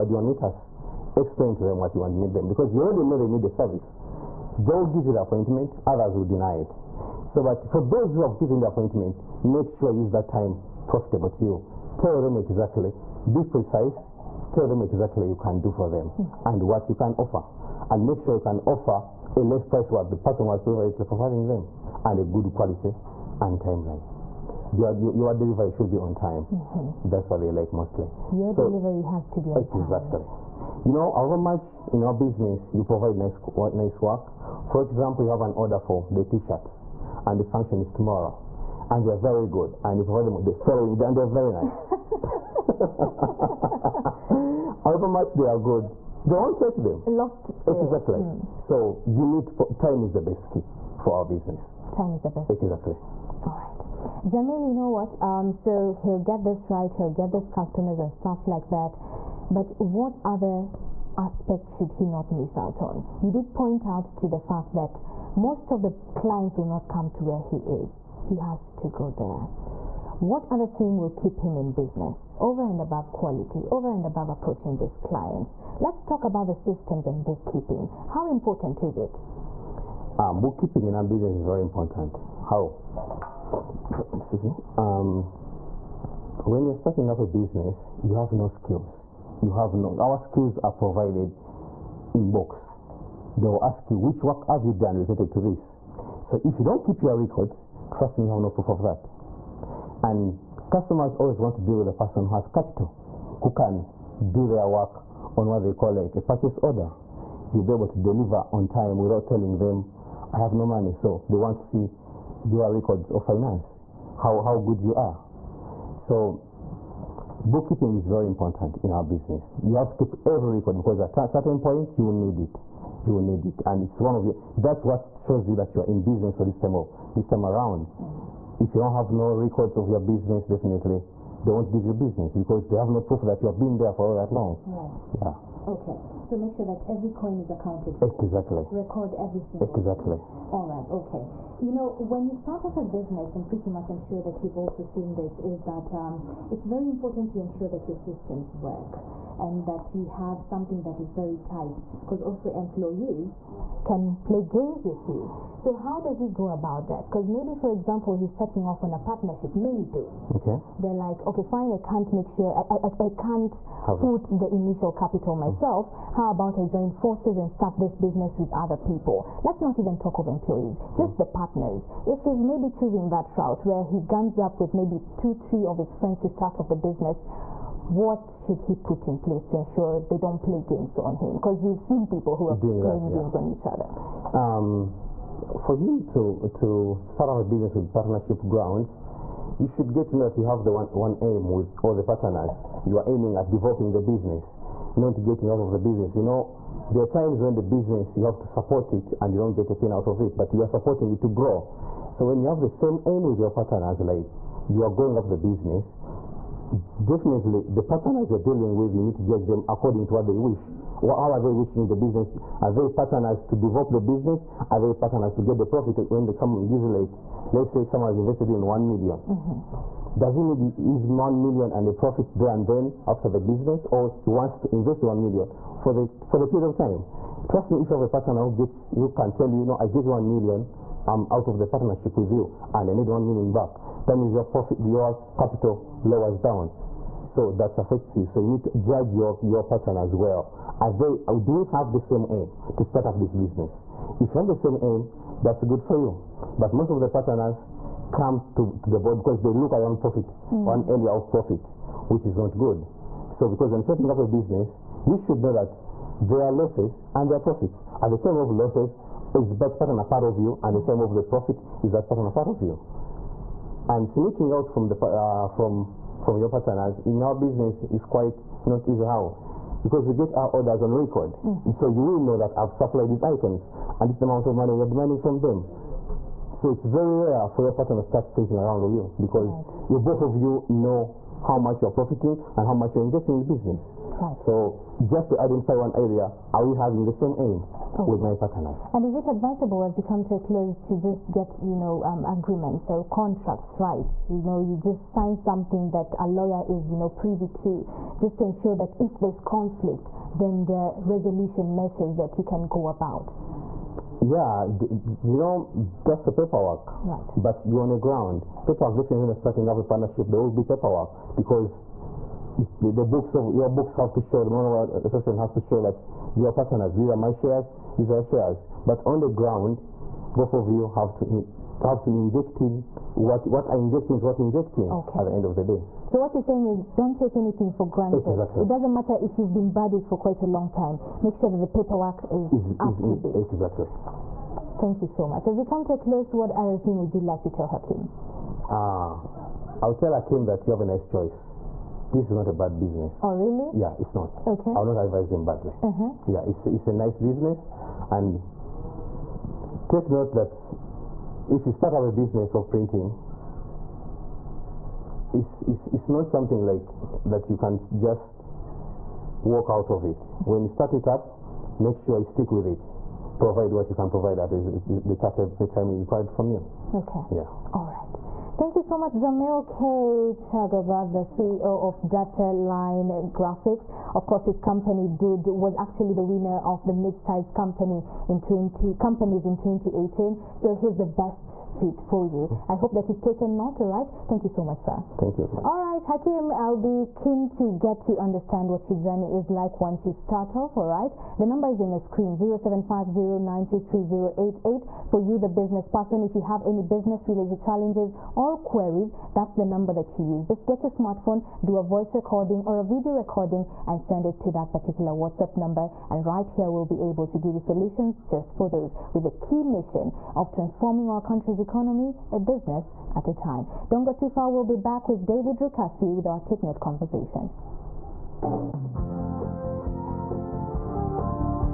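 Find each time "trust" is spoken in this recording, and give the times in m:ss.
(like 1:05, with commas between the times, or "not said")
1:37, 3:47.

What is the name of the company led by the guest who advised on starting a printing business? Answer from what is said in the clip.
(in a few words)
Data Line Graphics.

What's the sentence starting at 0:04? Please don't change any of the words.
They'll give you the appointment, others will deny it.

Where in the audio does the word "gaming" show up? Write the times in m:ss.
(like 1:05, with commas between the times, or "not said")
not said.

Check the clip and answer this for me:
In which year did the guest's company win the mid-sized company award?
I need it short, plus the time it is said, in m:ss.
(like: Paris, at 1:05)
2018, at 6:19.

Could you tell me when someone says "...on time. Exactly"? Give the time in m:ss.
0:29.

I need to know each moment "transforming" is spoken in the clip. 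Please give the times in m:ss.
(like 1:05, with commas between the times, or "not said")
6:50.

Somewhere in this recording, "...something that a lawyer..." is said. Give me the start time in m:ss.
4:55.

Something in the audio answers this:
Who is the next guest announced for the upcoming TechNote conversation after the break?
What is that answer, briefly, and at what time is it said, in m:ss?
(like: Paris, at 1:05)
David Rukasi, at 6:55.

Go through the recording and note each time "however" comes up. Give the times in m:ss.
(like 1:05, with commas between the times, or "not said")
0:31, 0:44.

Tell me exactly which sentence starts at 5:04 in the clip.
Yeah, you know, that's the paperwork.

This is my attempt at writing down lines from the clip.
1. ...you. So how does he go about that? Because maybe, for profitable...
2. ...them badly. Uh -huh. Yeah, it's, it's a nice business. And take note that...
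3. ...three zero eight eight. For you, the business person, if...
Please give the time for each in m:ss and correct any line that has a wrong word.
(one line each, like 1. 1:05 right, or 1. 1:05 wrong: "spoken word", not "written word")
1. 2:35 wrong: "example", not "profitable"
2. 5:45 right
3. 6:33 right.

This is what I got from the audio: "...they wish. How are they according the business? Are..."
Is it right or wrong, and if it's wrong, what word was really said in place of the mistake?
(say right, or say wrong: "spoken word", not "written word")
wrong: "wishing", not "according".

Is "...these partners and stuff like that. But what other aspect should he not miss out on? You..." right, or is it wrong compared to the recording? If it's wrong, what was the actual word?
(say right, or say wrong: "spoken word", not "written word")
wrong: "customers", not "partners".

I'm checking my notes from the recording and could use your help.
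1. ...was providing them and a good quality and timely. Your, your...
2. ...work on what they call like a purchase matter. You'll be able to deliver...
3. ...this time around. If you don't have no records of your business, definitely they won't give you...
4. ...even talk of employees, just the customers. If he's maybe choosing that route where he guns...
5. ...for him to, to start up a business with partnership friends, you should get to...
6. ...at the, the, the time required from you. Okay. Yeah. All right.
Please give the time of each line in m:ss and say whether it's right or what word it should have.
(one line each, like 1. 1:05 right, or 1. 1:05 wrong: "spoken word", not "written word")
1. 0:20 right
2. 1:44 wrong: "order", not "matter"
3. 2:07 right
4. 2:49 wrong: "partners", not "customers"
5. 3:05 wrong: "grounds", not "friends"
6. 6:04 right.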